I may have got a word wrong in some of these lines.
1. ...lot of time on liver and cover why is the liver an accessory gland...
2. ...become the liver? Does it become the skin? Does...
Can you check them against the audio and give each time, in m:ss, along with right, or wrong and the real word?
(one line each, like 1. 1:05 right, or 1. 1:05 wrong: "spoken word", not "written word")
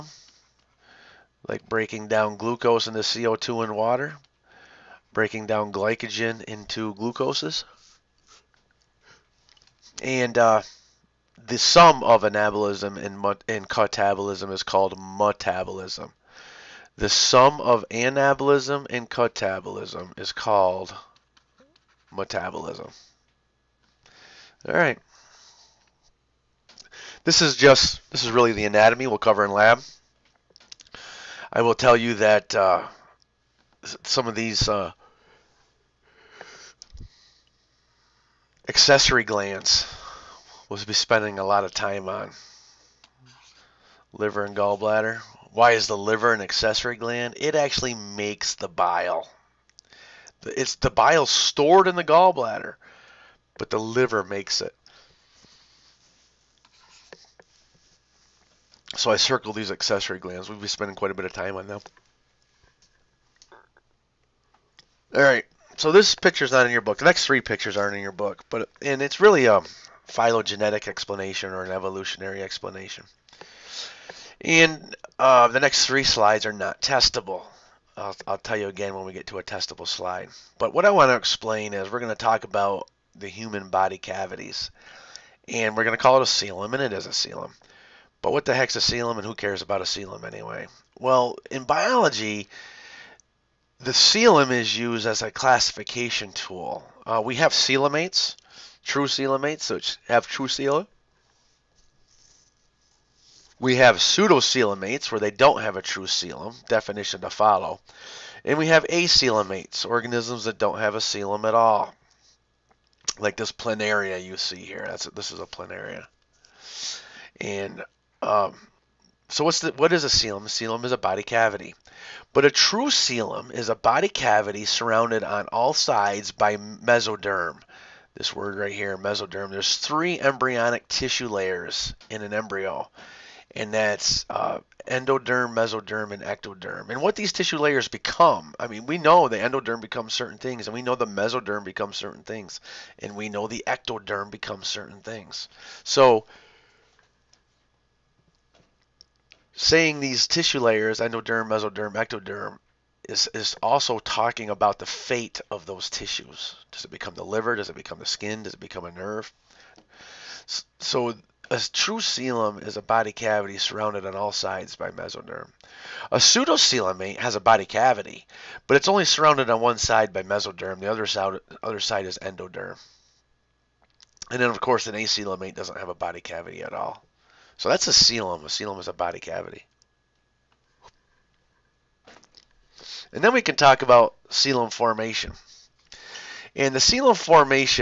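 1. 0:41 wrong: "gallbladder", not "cover"
2. 2:36 right.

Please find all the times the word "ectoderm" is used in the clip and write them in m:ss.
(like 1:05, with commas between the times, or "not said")
2:16, 2:23, 2:31.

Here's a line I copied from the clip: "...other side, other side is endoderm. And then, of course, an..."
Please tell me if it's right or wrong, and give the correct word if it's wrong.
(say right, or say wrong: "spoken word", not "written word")
right.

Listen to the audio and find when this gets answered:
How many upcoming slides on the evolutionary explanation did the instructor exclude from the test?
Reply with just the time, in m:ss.
1:15.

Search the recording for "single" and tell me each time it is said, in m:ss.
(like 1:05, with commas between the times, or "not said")
not said.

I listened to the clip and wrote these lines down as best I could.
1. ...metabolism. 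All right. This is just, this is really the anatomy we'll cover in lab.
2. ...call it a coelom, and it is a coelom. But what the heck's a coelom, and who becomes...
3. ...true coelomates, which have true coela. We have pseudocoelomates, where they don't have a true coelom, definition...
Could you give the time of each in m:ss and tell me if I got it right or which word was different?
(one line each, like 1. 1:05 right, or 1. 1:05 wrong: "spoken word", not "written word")
1. 0:22 right
2. 1:26 wrong: "cares", not "becomes"
3. 1:38 right.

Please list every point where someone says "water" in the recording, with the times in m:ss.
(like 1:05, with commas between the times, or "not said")
0:03.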